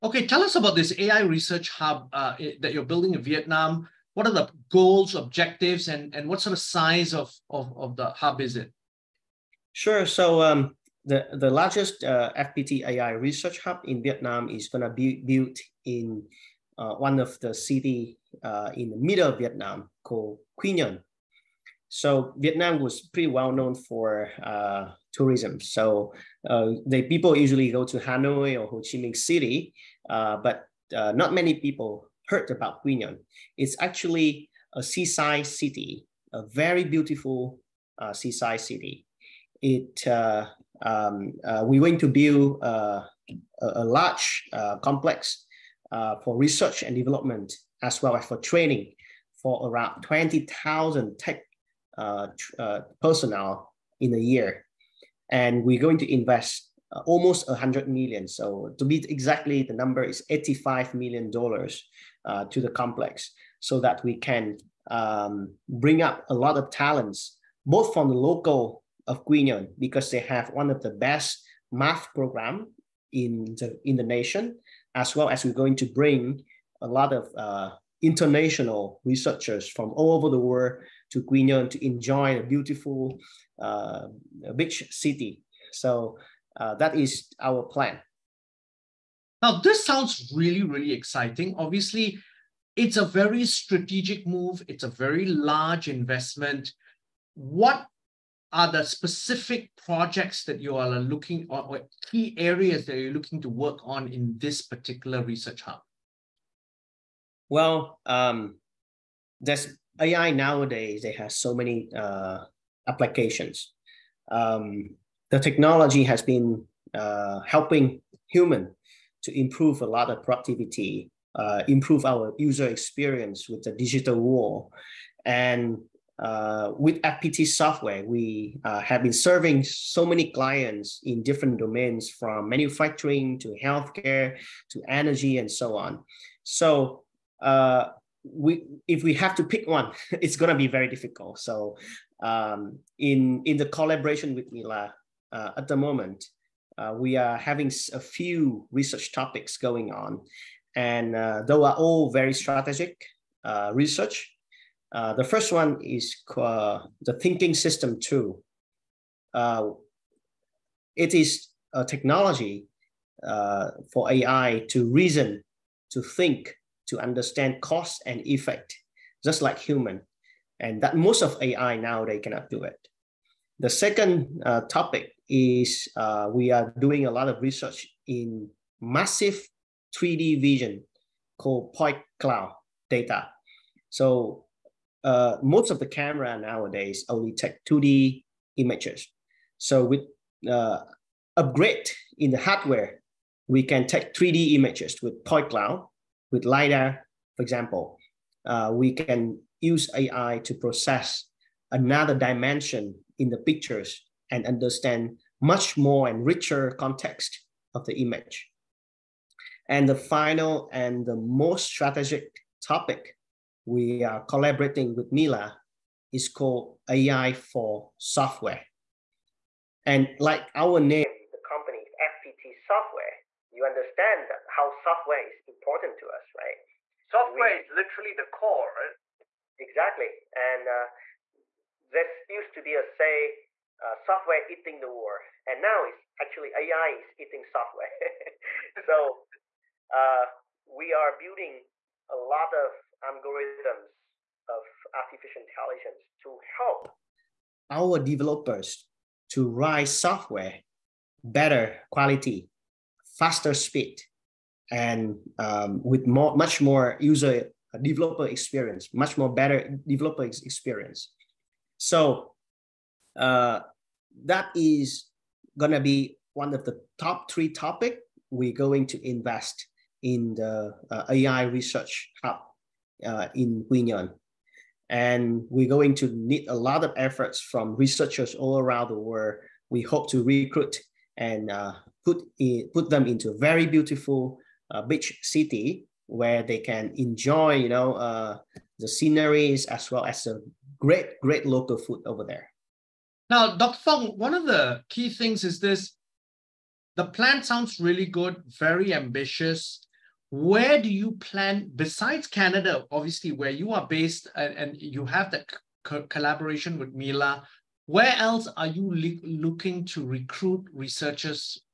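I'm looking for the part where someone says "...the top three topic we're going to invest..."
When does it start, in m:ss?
4:26.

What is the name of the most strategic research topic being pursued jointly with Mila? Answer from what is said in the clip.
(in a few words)
AI for software.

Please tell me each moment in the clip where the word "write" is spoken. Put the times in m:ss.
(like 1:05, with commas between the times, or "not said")
4:09.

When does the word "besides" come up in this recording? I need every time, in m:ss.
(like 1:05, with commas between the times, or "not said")
5:01.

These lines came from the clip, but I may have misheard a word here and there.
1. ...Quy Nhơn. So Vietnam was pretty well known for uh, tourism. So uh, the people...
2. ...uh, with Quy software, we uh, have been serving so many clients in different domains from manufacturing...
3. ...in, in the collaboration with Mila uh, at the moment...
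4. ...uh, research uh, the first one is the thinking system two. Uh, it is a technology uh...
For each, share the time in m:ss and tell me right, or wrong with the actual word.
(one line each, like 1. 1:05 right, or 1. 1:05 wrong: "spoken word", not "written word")
1. 0:20 right
2. 2:06 wrong: "FPT", not "Quy"
3. 2:22 right
4. 2:33 right.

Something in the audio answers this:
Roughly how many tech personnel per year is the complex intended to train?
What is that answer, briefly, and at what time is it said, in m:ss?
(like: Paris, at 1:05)
20,000, at 0:50.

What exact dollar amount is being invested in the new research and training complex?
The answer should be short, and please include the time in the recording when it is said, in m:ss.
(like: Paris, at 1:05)
85 million dollars, at 1:00.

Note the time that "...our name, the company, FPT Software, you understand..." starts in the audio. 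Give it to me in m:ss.
3:40.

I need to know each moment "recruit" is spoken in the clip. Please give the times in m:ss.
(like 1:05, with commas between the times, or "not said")
4:40, 5:10.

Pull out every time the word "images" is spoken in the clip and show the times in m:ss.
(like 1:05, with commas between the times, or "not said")
3:08, 3:14, 3:28.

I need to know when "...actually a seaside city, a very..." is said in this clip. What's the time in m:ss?
0:33.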